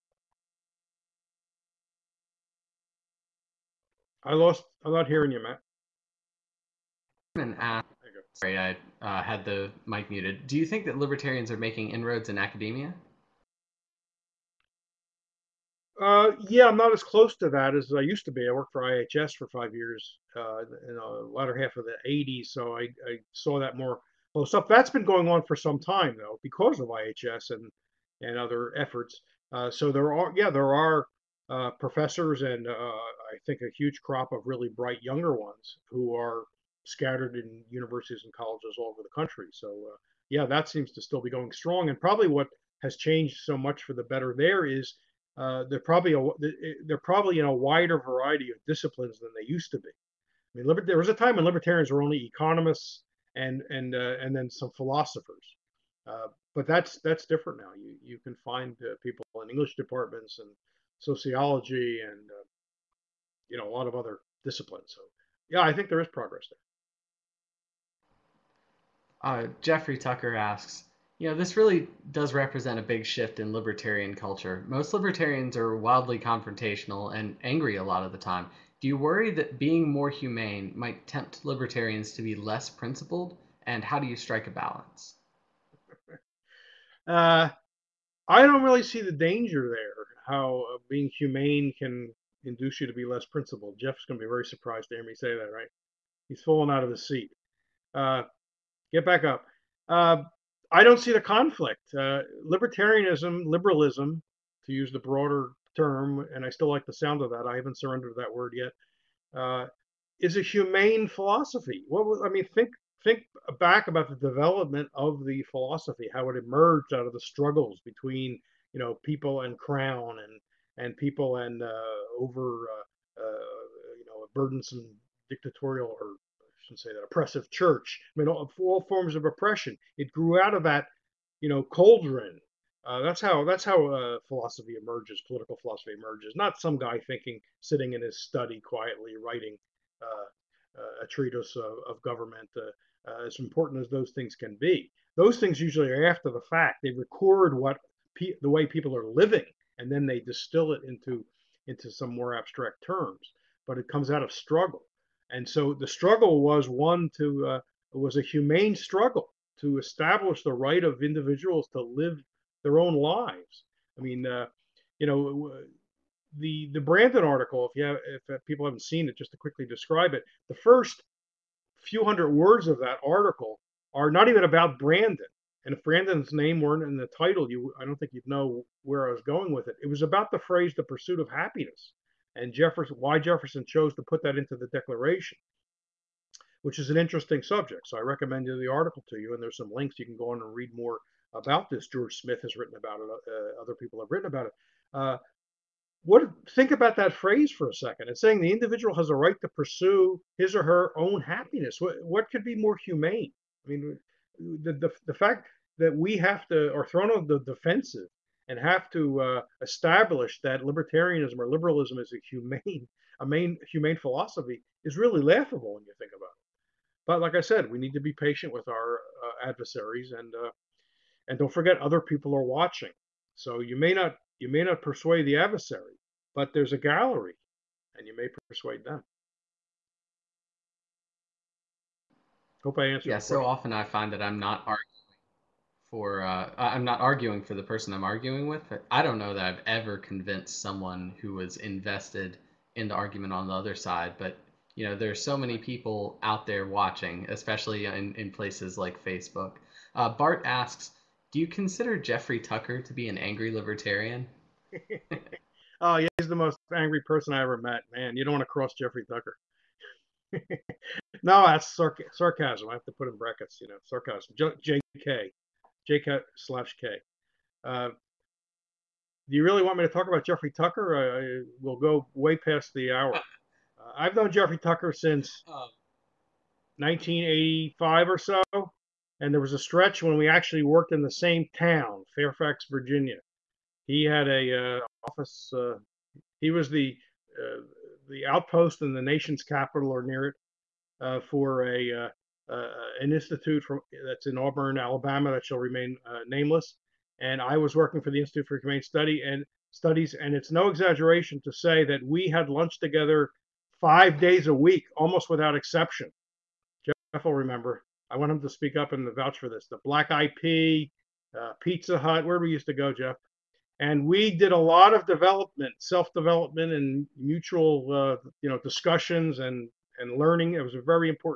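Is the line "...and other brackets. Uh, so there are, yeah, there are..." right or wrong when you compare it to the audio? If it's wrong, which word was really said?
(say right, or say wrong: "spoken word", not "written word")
wrong: "efforts", not "brackets".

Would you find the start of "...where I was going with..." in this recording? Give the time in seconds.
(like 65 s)
178 s.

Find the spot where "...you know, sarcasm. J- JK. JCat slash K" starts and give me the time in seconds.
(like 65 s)
263 s.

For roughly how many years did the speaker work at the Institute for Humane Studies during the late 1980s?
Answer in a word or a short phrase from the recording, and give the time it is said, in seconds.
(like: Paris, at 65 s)
5, at 19 s.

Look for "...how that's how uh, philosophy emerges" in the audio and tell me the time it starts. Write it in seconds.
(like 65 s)
133 s.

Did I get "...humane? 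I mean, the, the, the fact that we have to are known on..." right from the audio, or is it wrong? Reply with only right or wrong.
wrong.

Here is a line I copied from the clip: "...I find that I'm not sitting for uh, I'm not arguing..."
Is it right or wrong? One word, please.
wrong.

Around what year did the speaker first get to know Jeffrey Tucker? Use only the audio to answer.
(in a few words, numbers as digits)
1985.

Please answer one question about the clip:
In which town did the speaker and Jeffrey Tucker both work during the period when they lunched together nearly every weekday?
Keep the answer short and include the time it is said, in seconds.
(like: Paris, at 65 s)
Fairfax, Virginia, at 282 s.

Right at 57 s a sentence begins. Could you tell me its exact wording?
You you can find uh, people in English departments and sociology and uh, you know a lot of other disciplines.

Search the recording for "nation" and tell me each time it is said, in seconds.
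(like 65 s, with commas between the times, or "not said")
289 s.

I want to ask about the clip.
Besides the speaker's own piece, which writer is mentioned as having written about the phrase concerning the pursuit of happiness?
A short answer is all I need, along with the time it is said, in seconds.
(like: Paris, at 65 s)
George Smith, at 191 s.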